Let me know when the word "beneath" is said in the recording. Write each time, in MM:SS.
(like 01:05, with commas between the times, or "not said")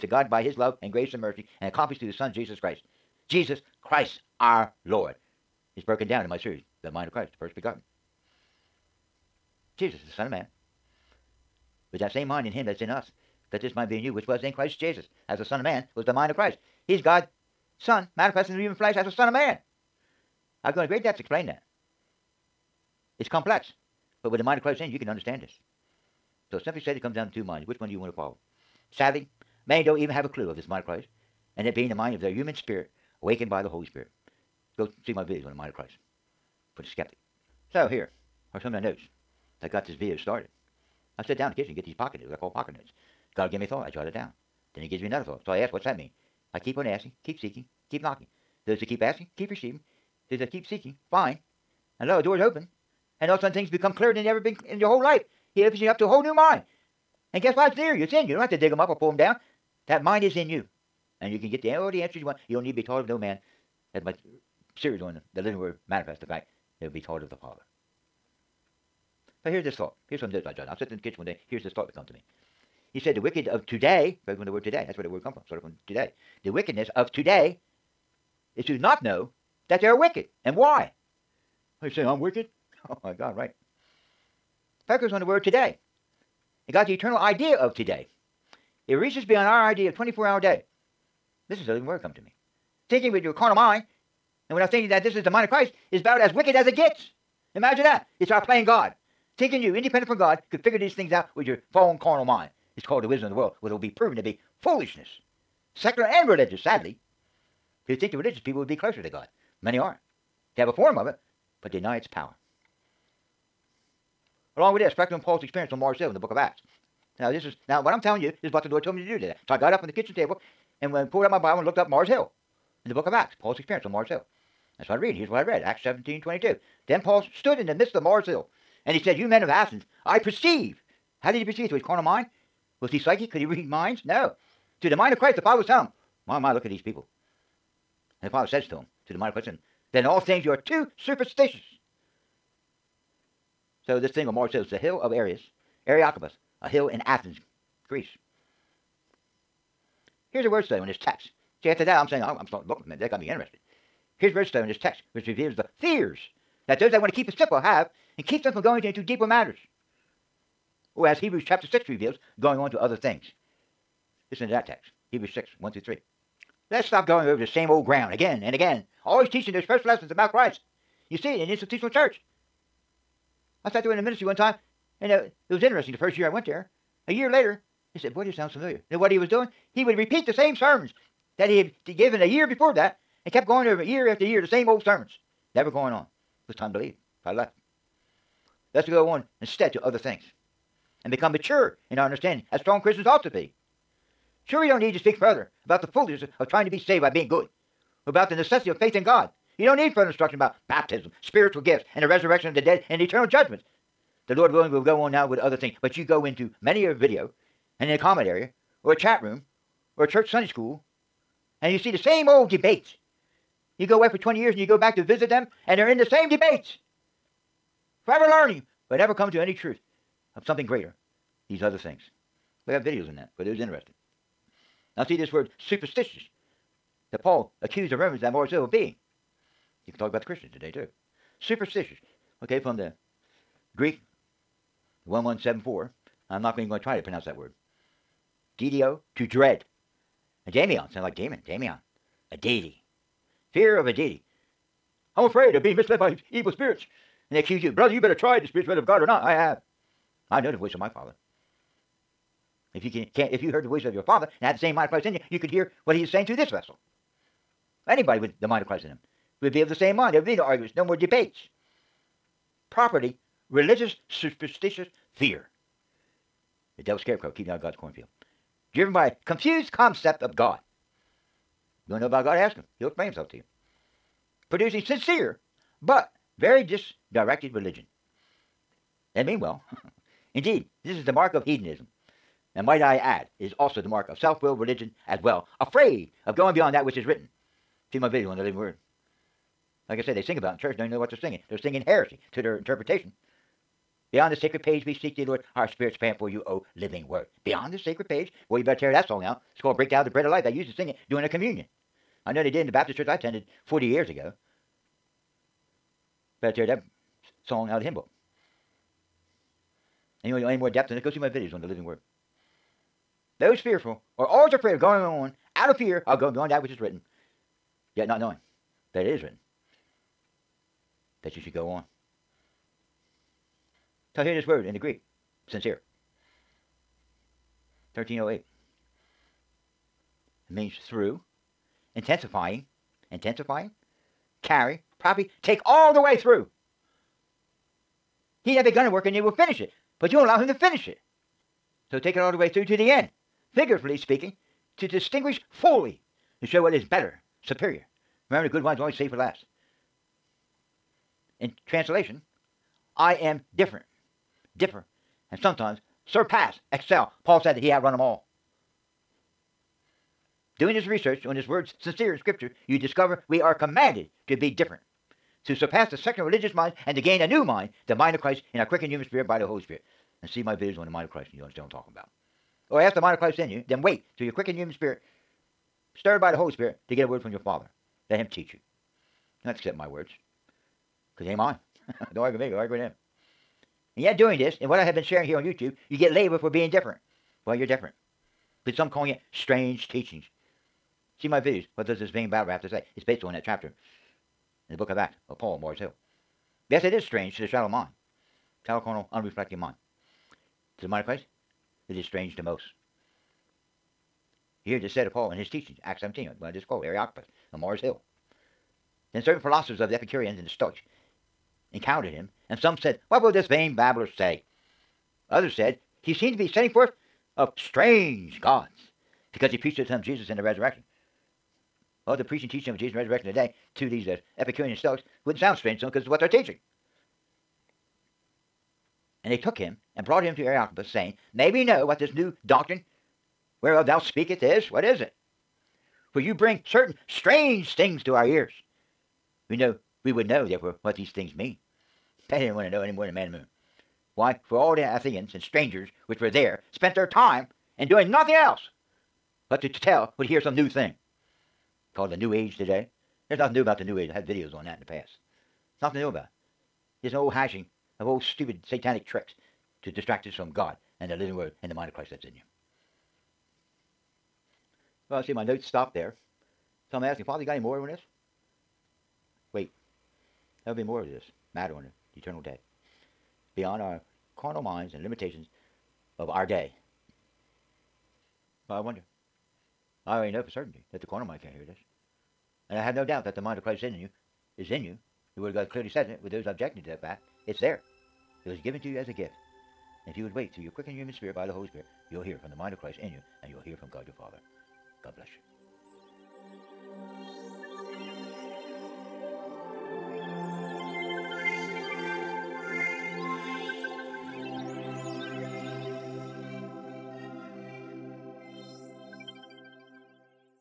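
not said.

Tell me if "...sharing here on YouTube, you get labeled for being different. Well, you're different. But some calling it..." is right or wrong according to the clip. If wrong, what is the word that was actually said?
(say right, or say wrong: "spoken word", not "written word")
right.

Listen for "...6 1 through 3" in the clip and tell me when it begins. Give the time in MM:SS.
02:45.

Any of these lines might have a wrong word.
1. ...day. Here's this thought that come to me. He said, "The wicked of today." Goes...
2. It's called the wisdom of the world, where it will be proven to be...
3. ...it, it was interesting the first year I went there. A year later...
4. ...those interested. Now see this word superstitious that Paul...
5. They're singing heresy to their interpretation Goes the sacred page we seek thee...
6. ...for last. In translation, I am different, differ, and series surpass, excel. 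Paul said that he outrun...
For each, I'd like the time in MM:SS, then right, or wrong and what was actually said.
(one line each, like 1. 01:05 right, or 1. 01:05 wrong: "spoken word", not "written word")
1. 01:11 right
2. 01:42 right
3. 02:55 right
4. 03:43 right
5. 04:51 wrong: "Beyond", not "Goes"
6. 05:49 wrong: "sometimes", not "series".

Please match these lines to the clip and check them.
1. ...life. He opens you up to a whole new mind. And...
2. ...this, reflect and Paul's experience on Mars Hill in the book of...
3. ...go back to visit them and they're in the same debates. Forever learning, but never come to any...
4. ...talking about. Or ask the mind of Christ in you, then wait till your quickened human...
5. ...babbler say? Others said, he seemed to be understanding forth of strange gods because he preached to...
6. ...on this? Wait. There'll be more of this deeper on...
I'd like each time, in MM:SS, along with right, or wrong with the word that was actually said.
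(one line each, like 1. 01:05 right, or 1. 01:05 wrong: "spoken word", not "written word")
1. 00:55 right
2. 01:54 right
3. 03:34 right
4. 06:11 right
5. 06:53 wrong: "setting", not "understanding"
6. 07:47 wrong: "matter", not "deeper".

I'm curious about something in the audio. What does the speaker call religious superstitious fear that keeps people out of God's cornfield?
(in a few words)
The devil's scarecrow.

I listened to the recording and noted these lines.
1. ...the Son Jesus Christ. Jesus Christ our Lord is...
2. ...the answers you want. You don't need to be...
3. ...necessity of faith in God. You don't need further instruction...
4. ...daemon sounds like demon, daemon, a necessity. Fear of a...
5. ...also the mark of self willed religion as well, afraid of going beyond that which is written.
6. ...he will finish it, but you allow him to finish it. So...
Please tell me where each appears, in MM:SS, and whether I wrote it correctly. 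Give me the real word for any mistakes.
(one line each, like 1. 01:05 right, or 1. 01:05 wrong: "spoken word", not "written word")
1. 00:02 right
2. 01:01 right
3. 03:18 right
4. 04:00 wrong: "deity", not "necessity"
5. 04:43 right
6. 05:39 right.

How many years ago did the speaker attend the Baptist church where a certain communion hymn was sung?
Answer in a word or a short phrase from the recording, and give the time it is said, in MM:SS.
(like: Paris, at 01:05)
40, at 05:03.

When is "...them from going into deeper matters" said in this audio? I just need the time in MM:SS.
02:38.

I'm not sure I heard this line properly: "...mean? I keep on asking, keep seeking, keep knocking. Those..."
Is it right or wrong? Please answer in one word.
right.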